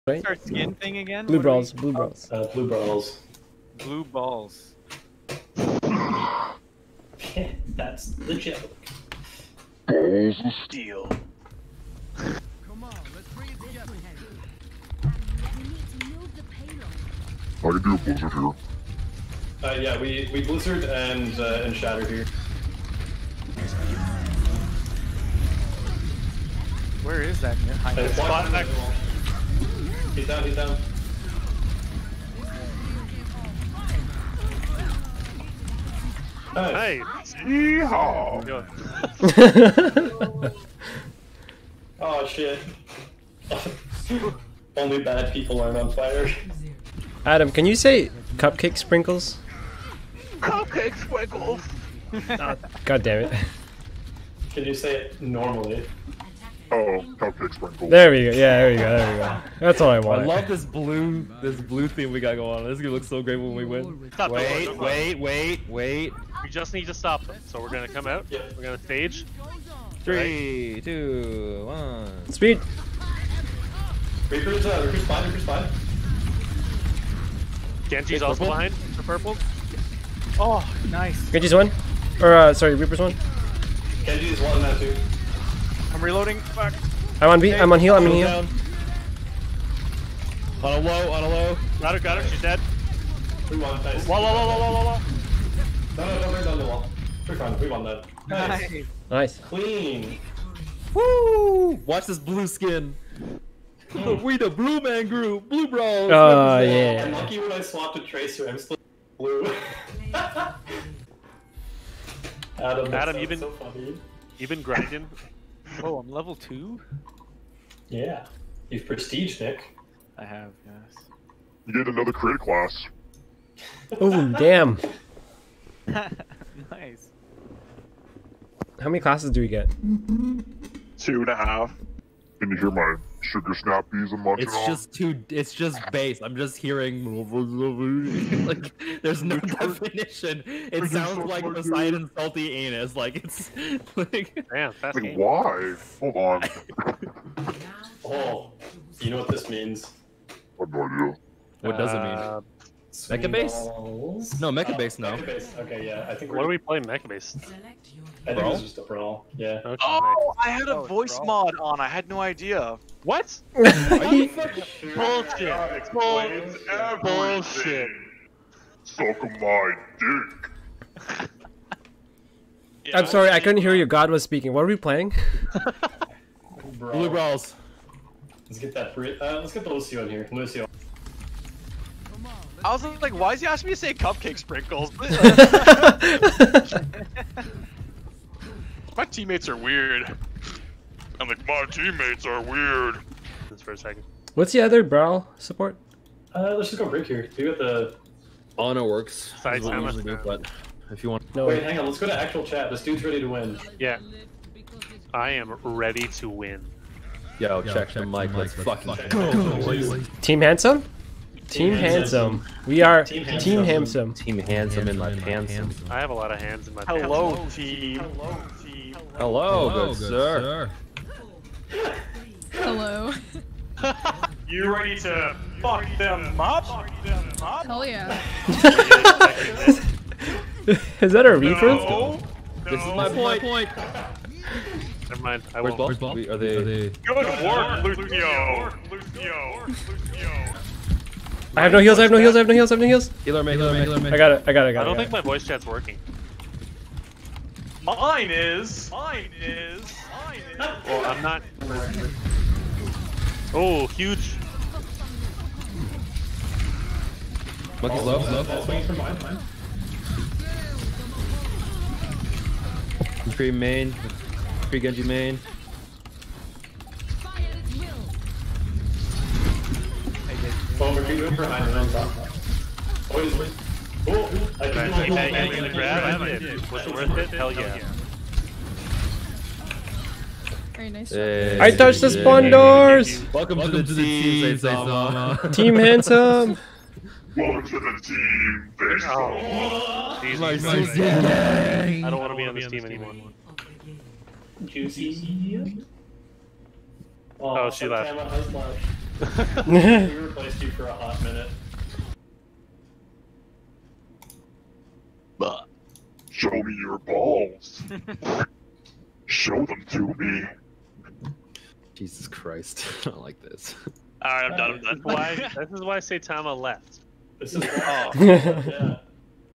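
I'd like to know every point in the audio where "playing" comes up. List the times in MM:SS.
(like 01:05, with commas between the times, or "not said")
02:36, 02:54.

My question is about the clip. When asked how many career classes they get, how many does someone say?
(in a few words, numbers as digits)
Two and a half.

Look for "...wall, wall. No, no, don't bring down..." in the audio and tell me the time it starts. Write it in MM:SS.
01:34.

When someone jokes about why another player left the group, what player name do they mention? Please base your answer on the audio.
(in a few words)
Saitama.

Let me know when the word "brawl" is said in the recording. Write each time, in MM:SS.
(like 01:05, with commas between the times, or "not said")
02:38, 02:57.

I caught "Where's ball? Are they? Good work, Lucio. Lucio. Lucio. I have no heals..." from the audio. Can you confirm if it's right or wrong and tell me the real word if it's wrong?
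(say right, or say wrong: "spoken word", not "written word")
right.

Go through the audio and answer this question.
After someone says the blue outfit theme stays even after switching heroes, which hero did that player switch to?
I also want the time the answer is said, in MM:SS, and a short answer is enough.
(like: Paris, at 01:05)
Tracer, at 01:48.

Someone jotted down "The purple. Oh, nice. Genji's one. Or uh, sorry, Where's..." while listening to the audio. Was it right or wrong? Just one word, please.
wrong.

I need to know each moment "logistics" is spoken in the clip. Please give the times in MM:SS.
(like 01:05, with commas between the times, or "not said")
not said.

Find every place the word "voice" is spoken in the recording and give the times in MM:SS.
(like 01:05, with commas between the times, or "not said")
02:40, 04:05.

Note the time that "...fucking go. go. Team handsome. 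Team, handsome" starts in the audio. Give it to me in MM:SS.
03:28.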